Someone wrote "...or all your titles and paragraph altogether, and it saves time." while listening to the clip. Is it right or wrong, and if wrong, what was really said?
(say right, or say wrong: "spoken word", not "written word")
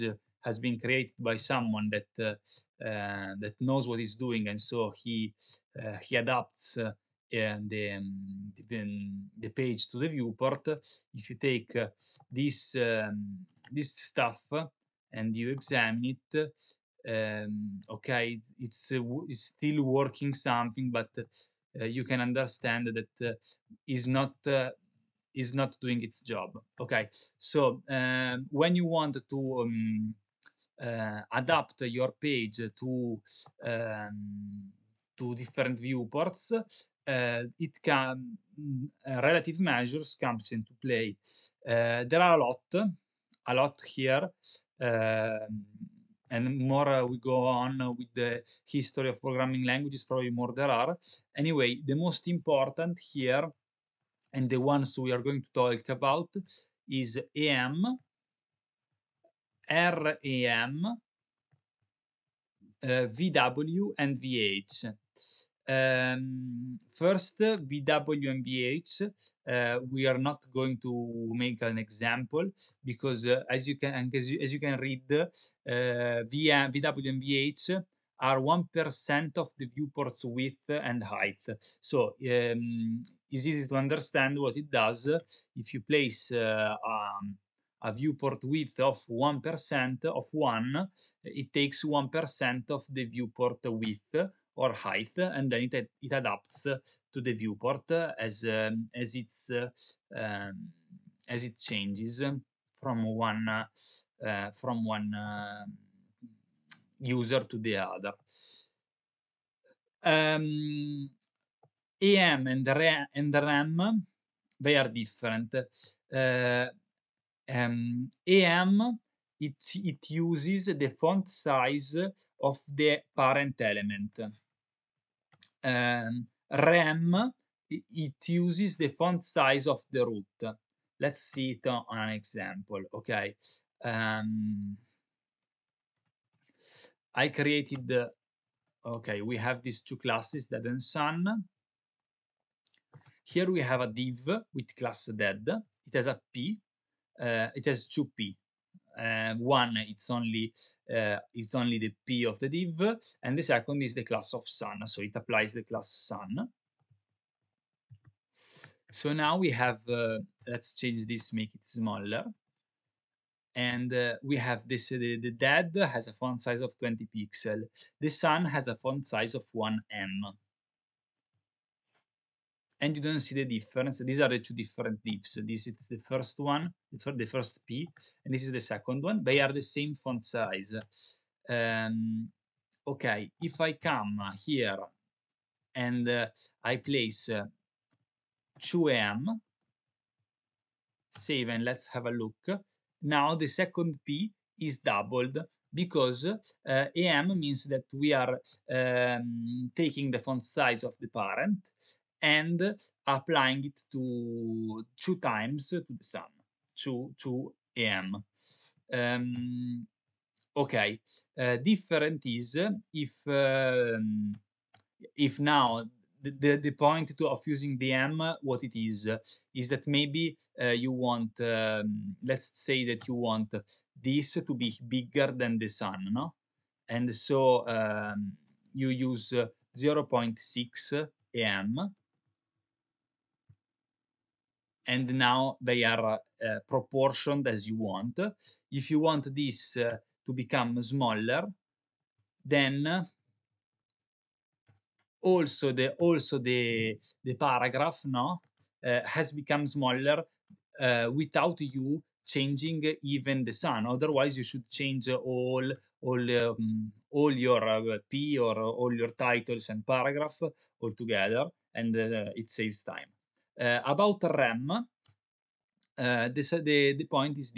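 right.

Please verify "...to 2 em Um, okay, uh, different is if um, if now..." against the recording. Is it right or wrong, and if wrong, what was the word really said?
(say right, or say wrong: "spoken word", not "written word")
right.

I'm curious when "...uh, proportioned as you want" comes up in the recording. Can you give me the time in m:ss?
3:56.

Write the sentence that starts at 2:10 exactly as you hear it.
Let's see it on an example, okay?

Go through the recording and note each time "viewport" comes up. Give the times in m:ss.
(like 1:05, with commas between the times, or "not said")
0:10, 0:35, 1:19, 1:27, 1:33, 1:37.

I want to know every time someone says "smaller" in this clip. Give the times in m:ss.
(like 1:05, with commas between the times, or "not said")
2:41, 4:00, 4:09.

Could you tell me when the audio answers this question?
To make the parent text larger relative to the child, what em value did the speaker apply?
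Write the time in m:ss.
3:49.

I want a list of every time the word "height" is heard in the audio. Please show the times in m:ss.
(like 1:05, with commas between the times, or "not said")
1:21, 1:34.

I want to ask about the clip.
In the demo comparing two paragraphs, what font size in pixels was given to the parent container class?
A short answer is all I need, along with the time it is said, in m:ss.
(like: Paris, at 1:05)
20 pixels, at 2:46.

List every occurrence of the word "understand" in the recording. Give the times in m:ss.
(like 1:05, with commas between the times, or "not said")
0:22, 1:23.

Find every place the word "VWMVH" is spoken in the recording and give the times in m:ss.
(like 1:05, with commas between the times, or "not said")
1:07, 1:16.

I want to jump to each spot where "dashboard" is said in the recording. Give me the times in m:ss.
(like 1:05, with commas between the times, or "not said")
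not said.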